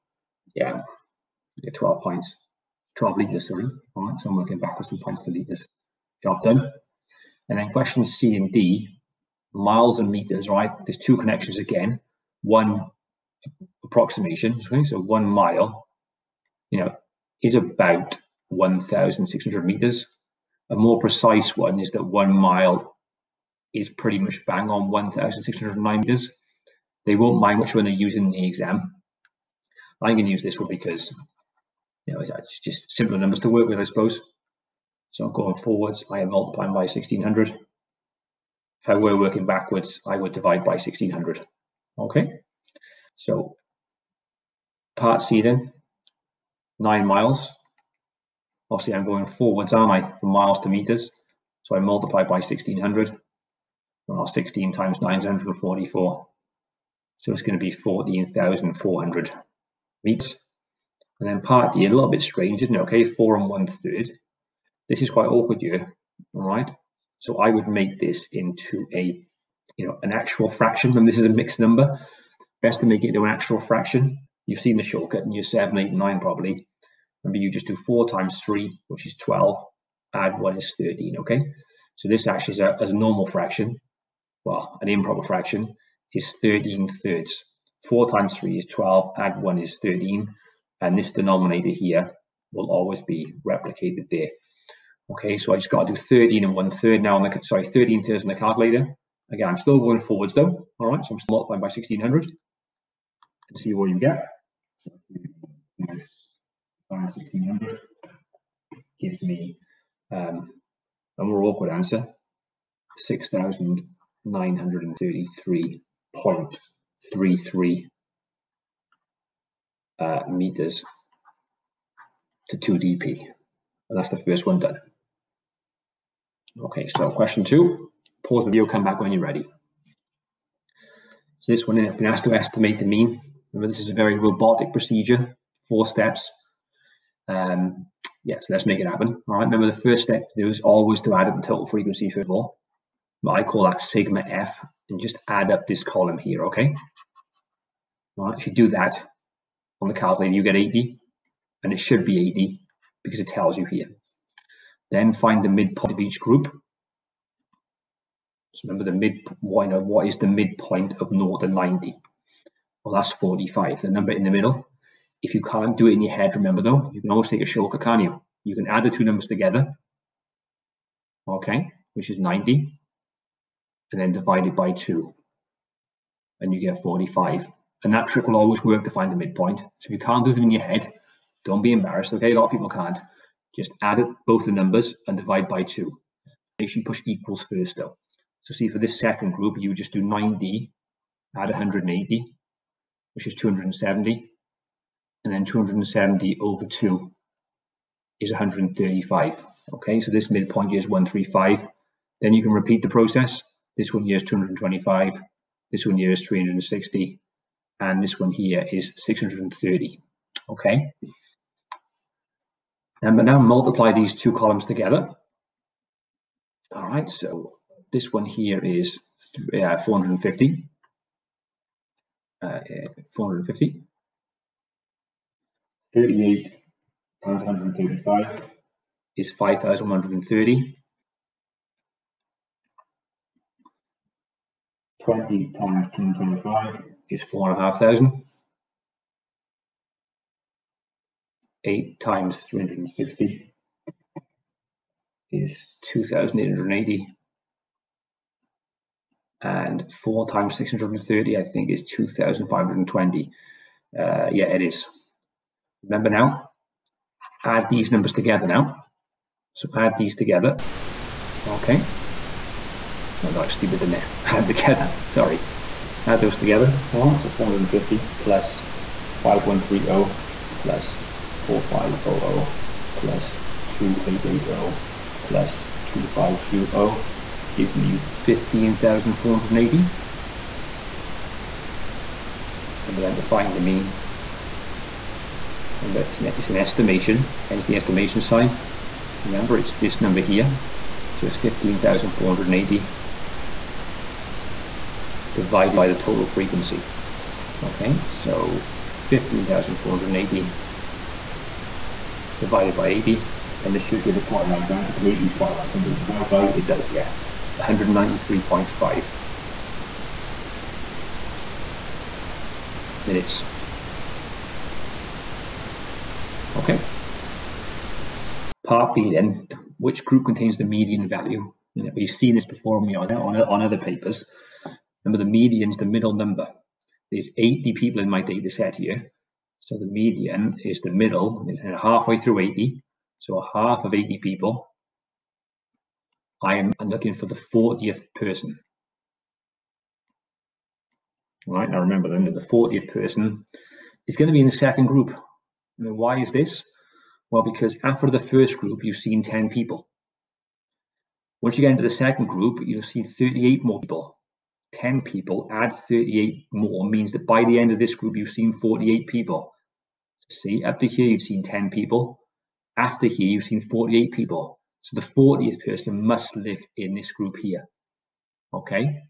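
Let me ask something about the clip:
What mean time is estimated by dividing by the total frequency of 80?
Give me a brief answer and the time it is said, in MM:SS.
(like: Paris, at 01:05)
193.5 minutes, at 05:07.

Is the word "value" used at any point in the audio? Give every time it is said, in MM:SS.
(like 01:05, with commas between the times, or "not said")
05:21.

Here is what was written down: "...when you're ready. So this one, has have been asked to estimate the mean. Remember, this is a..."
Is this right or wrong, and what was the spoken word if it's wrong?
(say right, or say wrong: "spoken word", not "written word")
right.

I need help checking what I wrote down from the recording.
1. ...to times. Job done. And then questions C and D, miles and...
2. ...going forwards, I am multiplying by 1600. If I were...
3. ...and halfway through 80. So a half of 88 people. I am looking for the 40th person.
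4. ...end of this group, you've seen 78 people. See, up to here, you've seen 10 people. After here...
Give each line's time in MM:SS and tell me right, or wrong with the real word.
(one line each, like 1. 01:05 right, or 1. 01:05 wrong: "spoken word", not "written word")
1. 00:05 wrong: "litres", not "times"
2. 00:35 right
3. 05:31 wrong: "80", not "88"
4. 05:57 wrong: "48", not "78".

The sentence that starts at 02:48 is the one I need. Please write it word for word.
You can add the two numbers together, okay, which is 90, and then divide it by 2, and you get 45.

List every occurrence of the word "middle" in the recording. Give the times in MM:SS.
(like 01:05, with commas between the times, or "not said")
02:44, 05:25, 05:30.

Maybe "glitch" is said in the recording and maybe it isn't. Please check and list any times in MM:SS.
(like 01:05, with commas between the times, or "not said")
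not said.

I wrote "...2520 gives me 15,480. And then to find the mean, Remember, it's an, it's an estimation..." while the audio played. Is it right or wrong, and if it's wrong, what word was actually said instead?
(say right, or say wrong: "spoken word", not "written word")
right.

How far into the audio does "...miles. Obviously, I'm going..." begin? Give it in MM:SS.
00:47.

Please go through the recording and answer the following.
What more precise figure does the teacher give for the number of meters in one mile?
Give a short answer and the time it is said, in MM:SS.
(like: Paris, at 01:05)
1,609 meters, at 00:24.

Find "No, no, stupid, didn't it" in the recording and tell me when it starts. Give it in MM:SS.
04:23.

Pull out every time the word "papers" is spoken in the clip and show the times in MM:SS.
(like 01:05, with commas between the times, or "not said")
05:23.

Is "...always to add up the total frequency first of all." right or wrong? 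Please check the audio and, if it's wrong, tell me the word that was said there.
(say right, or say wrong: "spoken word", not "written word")
right.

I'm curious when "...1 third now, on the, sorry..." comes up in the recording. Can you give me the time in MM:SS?
01:36.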